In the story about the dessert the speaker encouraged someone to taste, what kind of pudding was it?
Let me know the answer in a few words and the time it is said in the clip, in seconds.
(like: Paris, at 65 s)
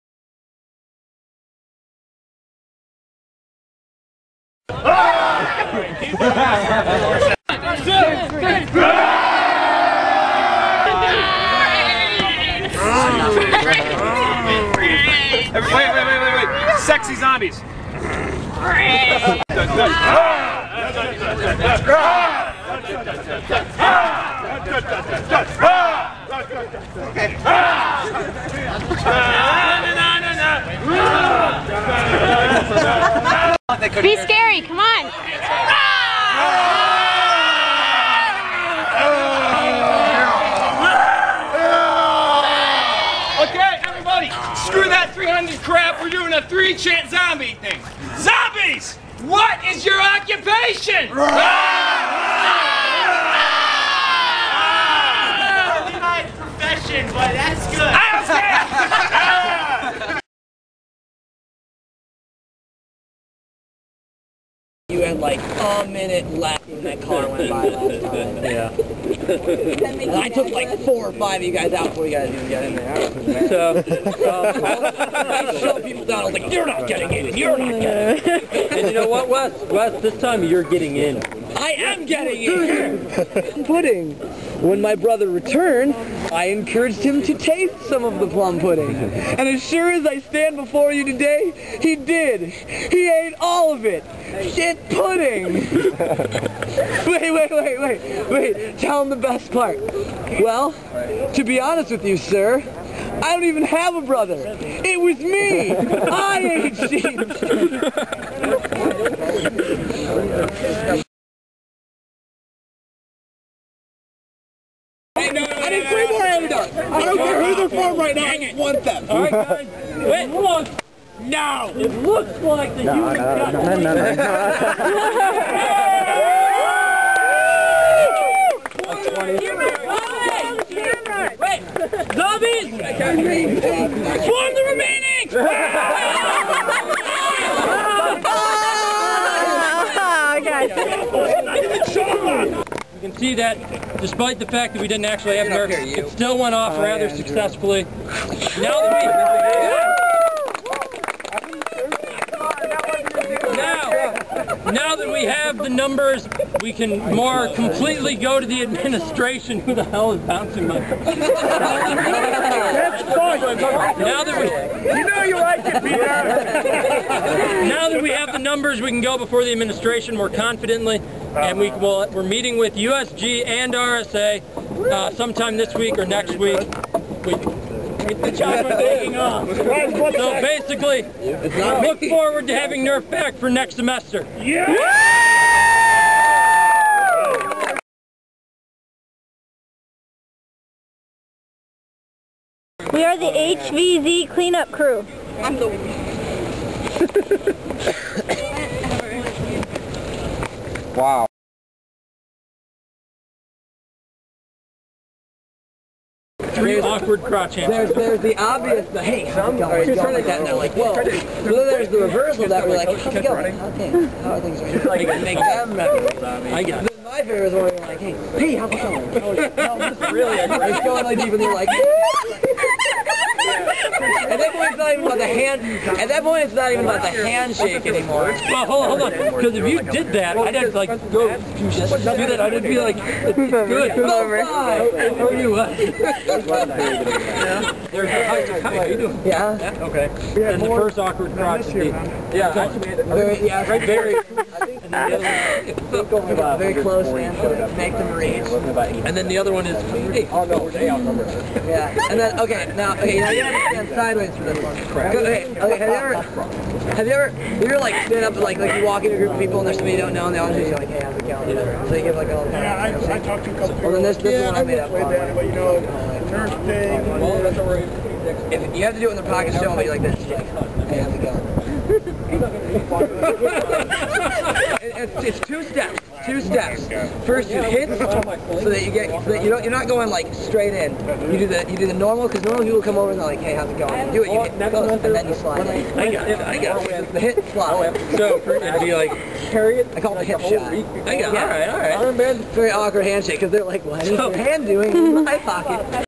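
Plum pudding, at 88 s.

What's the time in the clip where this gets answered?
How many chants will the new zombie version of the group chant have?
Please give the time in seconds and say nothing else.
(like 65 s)
46 s.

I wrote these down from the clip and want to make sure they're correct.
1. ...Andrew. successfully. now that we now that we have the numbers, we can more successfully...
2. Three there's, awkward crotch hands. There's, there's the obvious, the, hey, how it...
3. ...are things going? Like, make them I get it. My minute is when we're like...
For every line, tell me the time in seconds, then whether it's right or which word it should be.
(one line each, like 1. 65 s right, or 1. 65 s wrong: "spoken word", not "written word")
1. 147 s wrong: "completely", not "successfully"
2. 206 s right
3. 214 s wrong: "favorite", not "minute".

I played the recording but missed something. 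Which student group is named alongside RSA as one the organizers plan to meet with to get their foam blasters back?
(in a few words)
USG.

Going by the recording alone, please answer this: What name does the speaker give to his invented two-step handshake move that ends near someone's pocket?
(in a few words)
The hip shot.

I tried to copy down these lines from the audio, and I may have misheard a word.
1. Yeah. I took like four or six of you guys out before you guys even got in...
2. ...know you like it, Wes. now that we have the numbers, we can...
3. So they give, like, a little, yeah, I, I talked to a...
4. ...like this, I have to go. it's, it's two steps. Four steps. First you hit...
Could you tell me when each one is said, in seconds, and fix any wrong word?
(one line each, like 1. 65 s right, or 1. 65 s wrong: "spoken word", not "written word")
1. 68 s wrong: "five", not "six"
2. 165 s wrong: "Peter", not "Wes"
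3. 261 s right
4. 269 s wrong: "Two", not "Four".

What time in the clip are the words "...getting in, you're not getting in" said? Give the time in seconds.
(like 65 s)
76 s.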